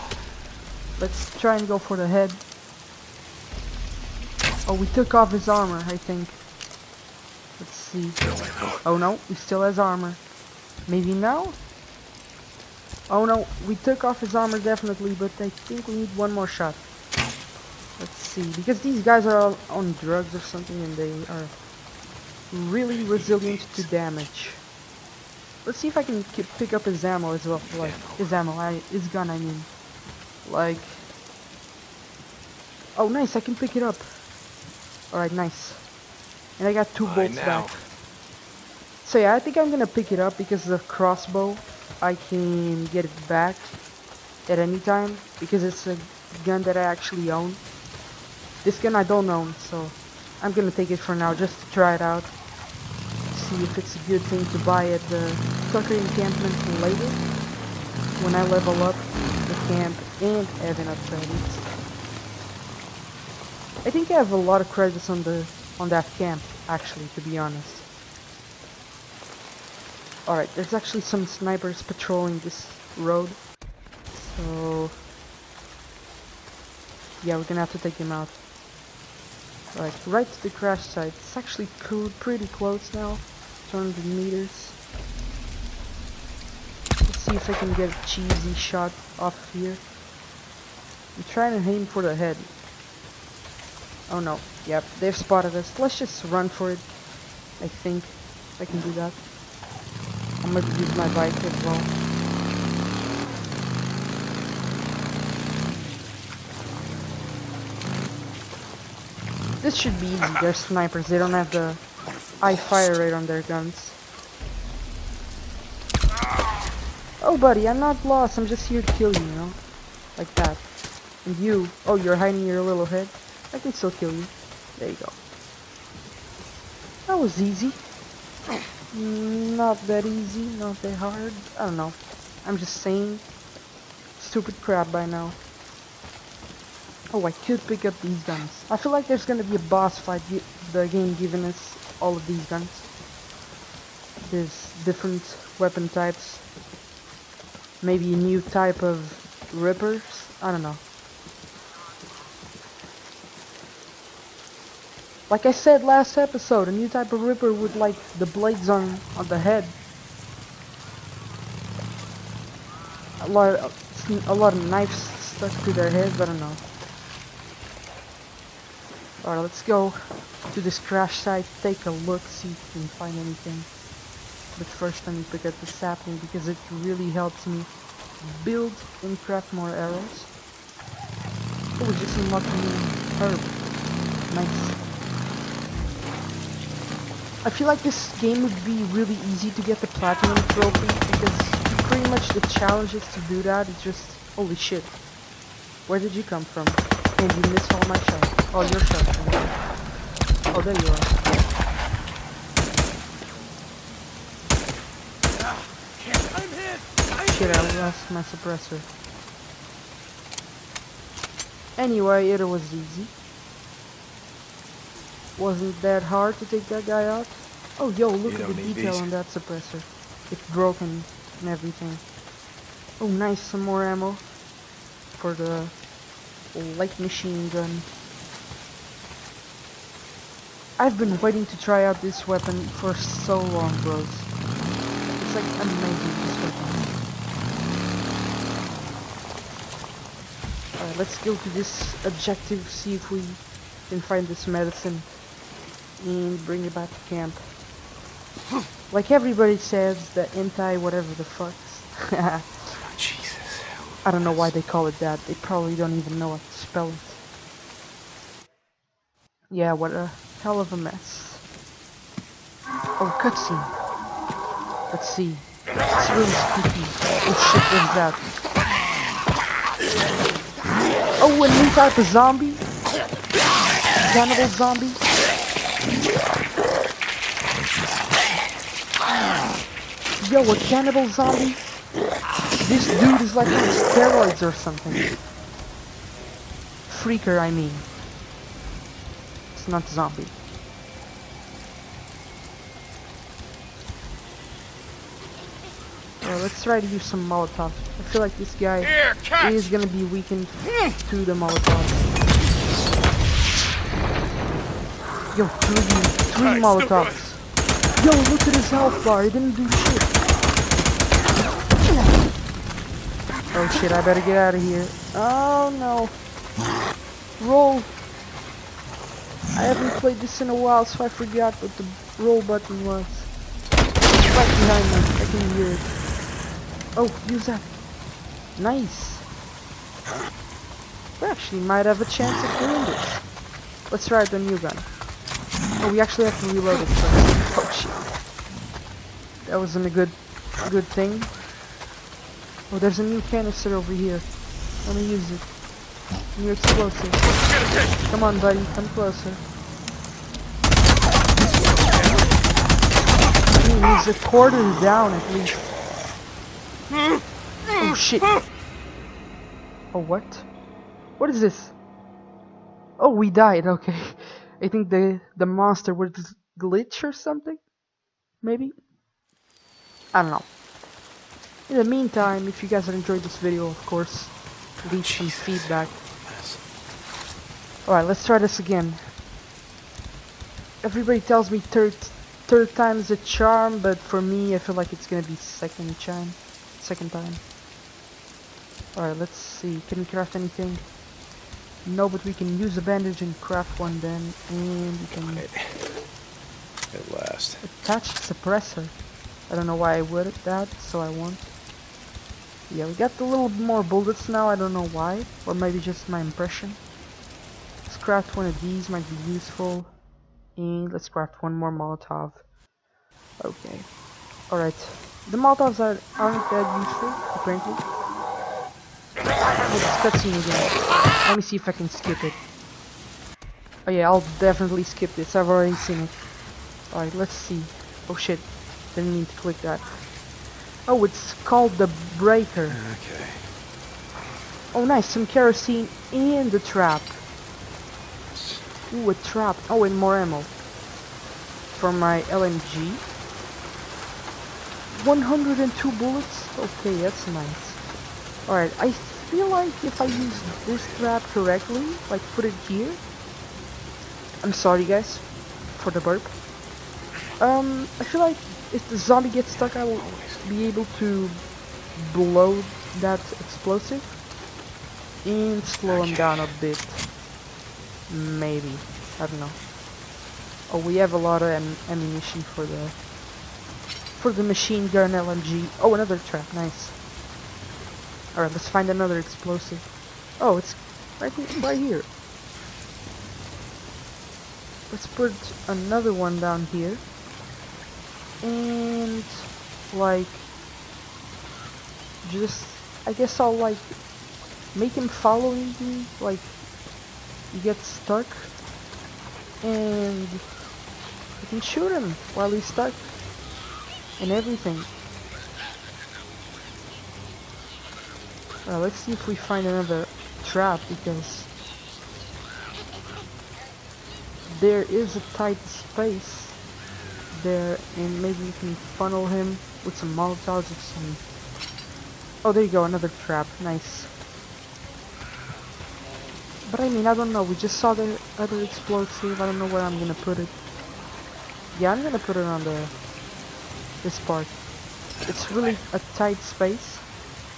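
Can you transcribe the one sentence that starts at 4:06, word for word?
And bring it back to camp.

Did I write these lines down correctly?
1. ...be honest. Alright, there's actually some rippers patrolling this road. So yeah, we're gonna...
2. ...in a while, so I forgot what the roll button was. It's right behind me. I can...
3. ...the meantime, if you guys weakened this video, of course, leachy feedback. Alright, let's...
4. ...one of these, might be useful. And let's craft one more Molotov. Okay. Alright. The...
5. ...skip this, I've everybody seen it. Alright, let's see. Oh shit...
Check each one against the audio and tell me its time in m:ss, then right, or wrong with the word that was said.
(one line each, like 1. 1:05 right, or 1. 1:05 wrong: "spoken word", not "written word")
1. 1:07 wrong: "snipers", not "rippers"
2. 5:20 right
3. 6:11 wrong: "enjoyed", not "weakened"
4. 6:48 right
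5. 7:04 wrong: "already", not "everybody".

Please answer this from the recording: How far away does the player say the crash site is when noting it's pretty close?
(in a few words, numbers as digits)
100 meters.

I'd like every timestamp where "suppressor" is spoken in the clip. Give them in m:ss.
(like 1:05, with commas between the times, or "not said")
3:28, 3:39, 6:38.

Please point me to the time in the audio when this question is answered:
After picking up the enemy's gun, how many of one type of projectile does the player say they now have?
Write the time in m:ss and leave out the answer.
0:36.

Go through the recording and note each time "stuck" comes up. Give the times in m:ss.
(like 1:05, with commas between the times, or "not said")
2:44, 7:39, 8:17, 8:22.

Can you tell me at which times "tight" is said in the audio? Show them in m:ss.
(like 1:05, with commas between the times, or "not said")
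8:35, 8:56.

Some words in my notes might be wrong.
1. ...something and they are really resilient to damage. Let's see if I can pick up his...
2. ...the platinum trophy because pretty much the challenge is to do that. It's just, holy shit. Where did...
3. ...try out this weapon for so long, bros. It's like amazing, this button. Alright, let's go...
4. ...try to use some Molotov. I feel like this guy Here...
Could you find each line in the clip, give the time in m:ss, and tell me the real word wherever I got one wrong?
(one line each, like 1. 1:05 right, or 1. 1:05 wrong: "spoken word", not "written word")
1. 0:20 right
2. 3:09 right
3. 3:51 wrong: "weapon", not "button"
4. 4:56 right.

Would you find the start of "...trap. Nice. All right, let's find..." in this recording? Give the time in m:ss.
7:56.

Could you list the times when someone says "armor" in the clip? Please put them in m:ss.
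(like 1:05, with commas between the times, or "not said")
0:05, 0:09, 0:14.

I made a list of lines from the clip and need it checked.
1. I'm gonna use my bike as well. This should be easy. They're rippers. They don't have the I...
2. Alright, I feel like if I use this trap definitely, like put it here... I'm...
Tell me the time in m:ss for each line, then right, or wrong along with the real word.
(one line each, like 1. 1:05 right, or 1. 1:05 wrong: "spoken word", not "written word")
1. 1:40 wrong: "snipers", not "rippers"
2. 7:28 wrong: "correctly", not "definitely".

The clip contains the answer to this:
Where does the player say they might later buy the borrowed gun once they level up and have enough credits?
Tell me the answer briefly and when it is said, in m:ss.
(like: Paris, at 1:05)
Tucker encampment, at 0:55.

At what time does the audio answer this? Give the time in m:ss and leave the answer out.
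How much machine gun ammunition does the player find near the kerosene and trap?
7:25.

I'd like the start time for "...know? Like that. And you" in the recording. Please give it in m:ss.
1:59.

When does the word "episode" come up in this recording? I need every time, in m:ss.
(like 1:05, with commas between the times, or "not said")
2:36.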